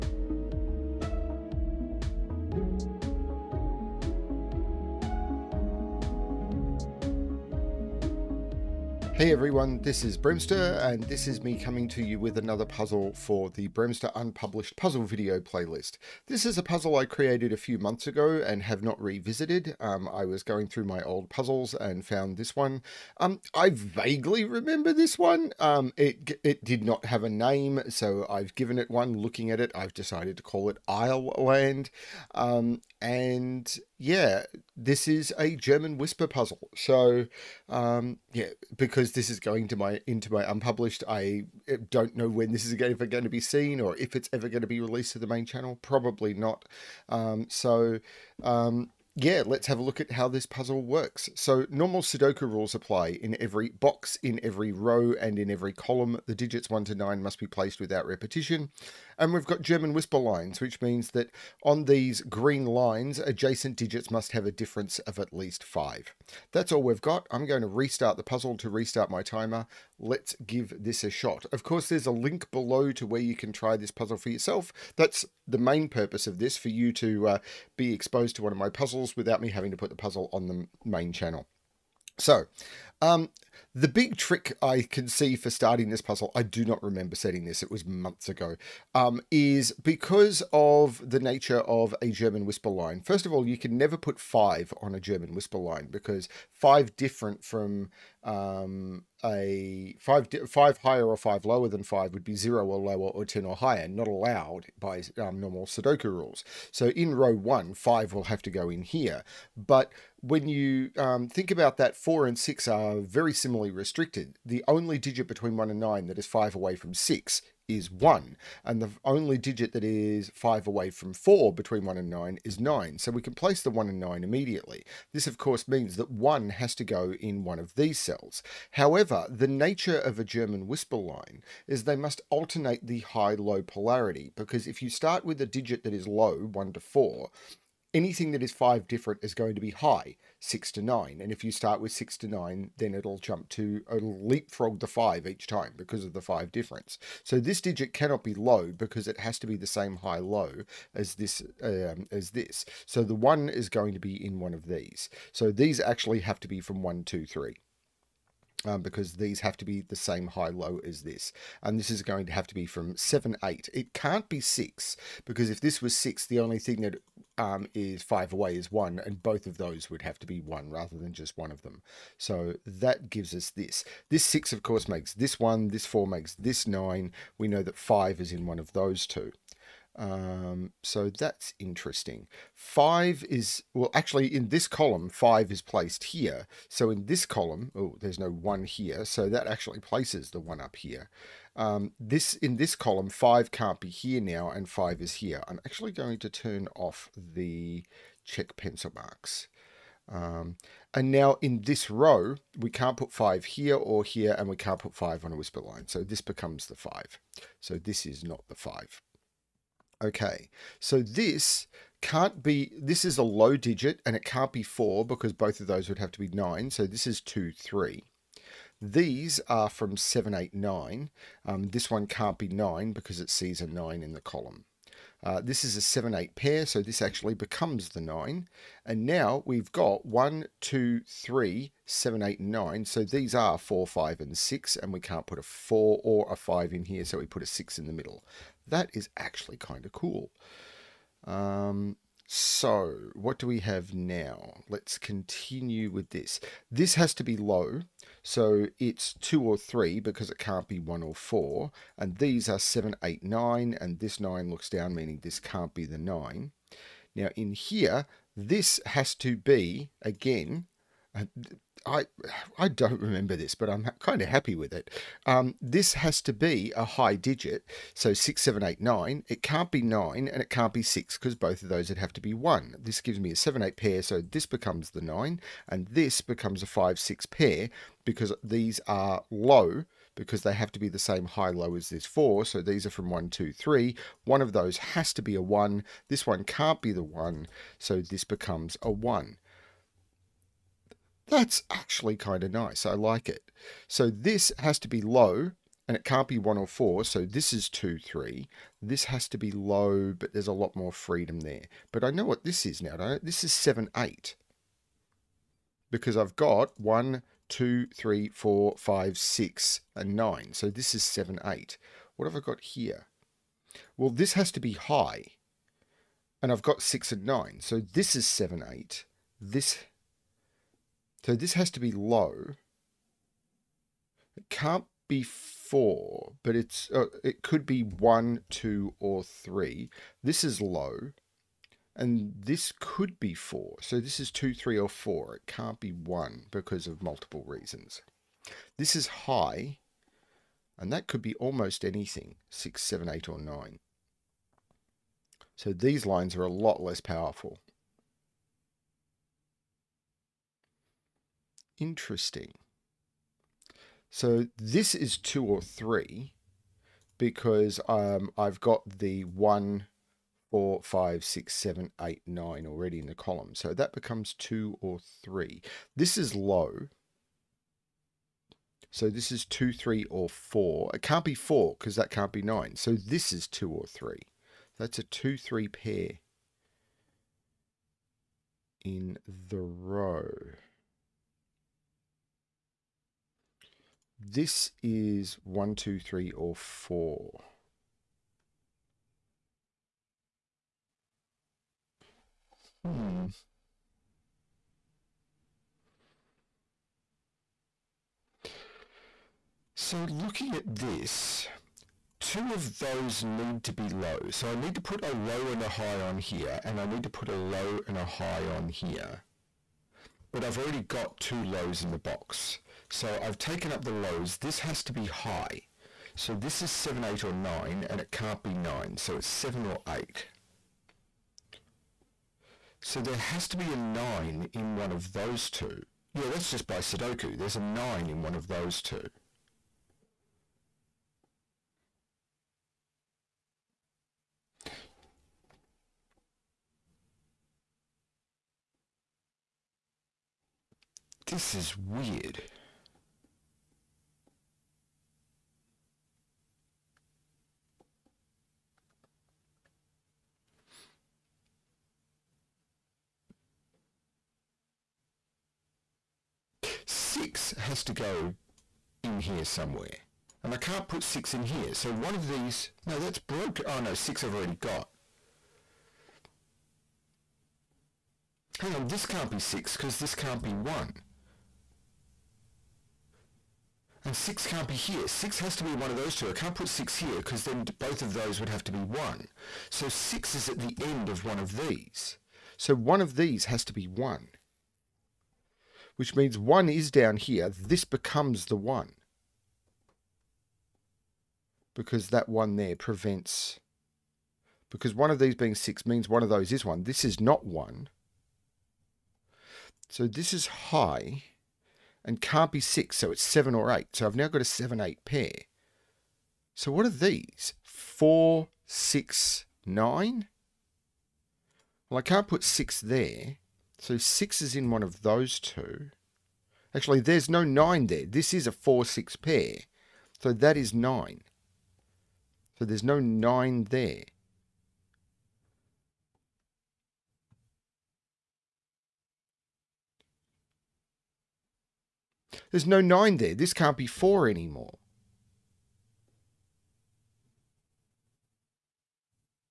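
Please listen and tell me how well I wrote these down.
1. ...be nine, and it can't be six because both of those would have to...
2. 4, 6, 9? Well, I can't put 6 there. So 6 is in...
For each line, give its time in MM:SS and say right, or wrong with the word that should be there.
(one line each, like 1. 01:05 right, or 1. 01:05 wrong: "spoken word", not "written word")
1. 04:29 right
2. 08:27 right.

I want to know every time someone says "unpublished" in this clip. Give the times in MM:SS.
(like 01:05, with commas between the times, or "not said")
00:14, 00:40.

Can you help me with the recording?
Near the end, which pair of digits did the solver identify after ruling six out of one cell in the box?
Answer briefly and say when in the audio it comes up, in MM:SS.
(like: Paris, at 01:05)
4-6 pair, at 08:38.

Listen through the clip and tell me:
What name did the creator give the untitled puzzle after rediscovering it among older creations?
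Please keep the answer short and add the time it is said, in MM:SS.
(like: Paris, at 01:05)
AisleLand, at 00:30.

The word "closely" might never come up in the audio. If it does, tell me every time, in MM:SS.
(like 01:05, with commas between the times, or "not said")
not said.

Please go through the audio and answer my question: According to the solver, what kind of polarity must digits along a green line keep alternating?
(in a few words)
high-low polarity.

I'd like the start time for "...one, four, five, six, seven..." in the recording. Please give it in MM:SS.
05:59.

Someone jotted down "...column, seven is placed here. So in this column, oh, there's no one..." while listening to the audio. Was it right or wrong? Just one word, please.
wrong.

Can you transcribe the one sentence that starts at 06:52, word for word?
So I've taken up the lows.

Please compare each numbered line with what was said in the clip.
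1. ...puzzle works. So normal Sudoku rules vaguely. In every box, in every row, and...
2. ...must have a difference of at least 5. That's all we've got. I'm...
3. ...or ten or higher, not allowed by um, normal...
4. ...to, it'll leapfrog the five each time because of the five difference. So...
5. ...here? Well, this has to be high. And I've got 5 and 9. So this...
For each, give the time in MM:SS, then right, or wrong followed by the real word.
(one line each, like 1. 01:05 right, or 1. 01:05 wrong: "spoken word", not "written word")
1. 00:50 wrong: "apply", not "vaguely"
2. 01:04 right
3. 01:43 right
4. 02:23 right
5. 05:12 wrong: "6", not "5".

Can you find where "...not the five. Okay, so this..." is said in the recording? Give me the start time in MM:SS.
03:28.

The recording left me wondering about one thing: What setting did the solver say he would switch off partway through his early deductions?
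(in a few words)
check pencil marks.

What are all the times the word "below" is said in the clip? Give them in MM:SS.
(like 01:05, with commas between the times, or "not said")
01:12.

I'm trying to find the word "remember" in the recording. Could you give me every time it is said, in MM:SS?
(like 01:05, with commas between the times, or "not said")
00:24, 01:26, 04:22.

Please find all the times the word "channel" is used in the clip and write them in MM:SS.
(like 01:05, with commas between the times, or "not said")
00:45, 01:21.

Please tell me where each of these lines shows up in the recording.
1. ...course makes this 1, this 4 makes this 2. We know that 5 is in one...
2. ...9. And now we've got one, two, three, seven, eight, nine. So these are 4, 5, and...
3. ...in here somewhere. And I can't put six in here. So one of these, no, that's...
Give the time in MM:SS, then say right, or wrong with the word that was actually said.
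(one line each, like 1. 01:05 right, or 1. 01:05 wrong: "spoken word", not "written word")
1. 02:54 wrong: "9", not "2"
2. 03:47 right
3. 07:39 right.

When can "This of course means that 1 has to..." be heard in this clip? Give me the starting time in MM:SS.
02:05.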